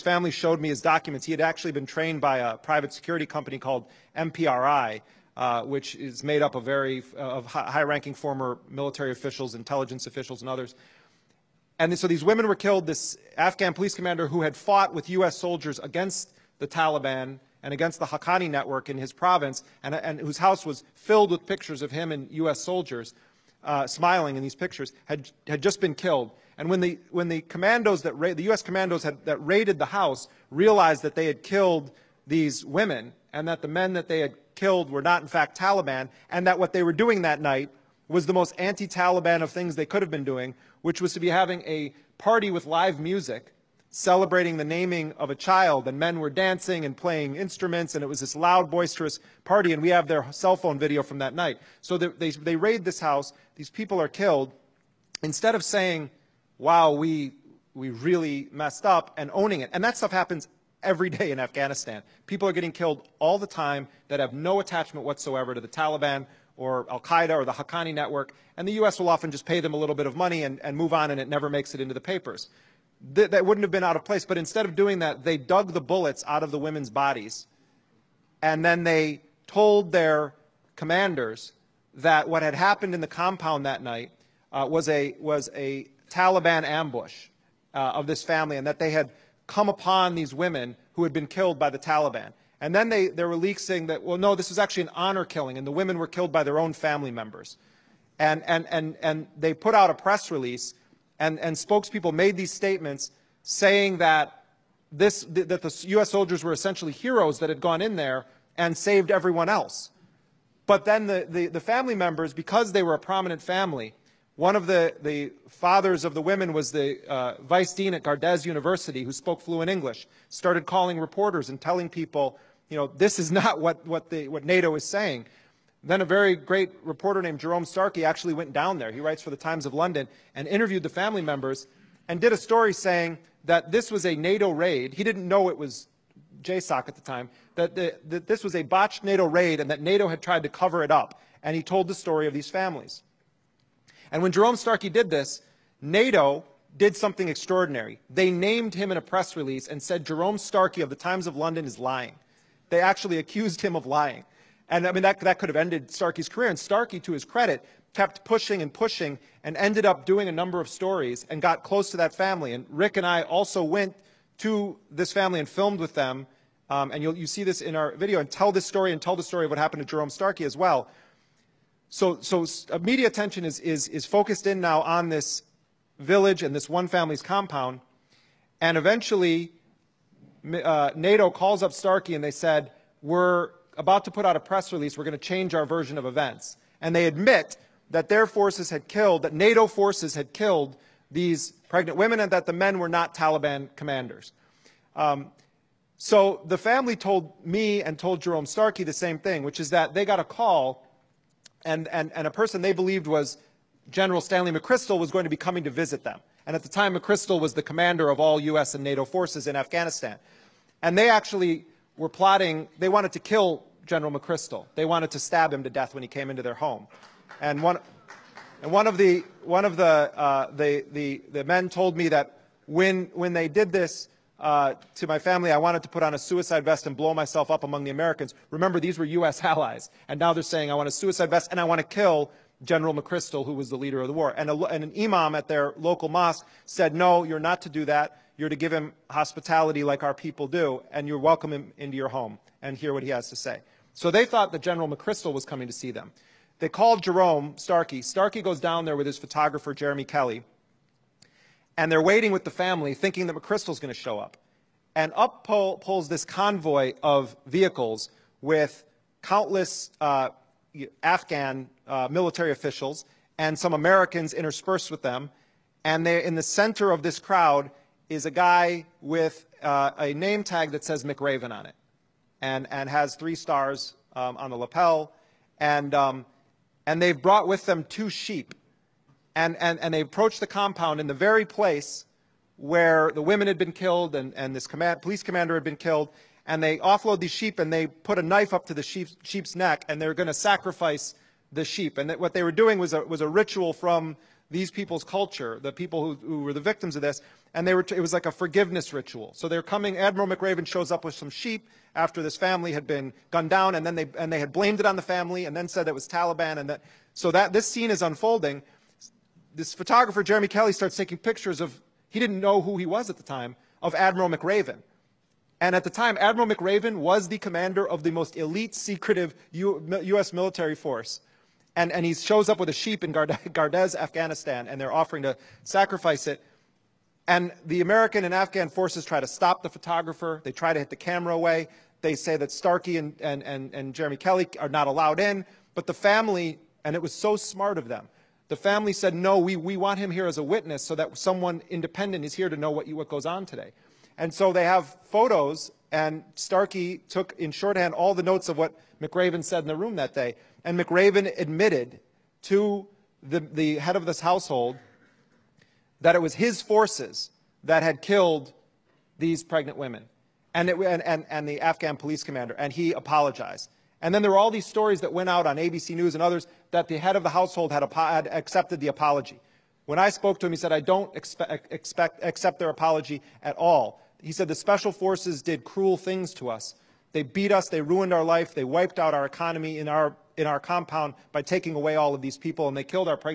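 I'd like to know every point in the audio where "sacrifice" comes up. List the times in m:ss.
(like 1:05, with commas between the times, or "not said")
4:50, 5:25.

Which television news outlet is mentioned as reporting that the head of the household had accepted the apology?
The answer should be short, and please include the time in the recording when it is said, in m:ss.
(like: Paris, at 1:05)
ABC News, at 6:05.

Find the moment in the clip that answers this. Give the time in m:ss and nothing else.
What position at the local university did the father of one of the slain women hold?
1:57.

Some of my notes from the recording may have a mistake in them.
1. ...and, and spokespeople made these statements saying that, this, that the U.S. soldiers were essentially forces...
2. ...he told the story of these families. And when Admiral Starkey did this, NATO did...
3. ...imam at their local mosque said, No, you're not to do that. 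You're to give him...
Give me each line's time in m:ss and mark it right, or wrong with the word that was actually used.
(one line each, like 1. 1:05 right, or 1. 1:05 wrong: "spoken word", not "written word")
1. 1:41 wrong: "heroes", not "forces"
2. 2:21 wrong: "Jerome", not "Admiral"
3. 3:54 right.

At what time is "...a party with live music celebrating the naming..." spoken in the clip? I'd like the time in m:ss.
0:41.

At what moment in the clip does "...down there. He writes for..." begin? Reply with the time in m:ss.
2:08.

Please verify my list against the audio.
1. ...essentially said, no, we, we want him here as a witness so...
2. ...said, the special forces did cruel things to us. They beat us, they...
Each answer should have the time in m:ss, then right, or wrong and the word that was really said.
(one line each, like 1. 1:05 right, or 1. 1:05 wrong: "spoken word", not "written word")
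1. 5:38 wrong: "family", not "essentially"
2. 6:14 right.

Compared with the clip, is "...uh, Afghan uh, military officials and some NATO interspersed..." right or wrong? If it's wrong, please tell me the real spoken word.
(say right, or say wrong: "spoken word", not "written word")
wrong: "Americans", not "NATO".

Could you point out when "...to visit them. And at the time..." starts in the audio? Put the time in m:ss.
3:25.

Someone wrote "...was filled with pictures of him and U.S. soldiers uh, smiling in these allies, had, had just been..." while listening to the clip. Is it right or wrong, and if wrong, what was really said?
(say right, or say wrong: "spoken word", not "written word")
wrong: "pictures", not "allies".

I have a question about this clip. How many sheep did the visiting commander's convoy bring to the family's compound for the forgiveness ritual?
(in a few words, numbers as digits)
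2.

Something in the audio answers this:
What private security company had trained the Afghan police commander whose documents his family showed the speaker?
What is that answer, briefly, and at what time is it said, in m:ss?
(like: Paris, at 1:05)
MPRI, at 0:04.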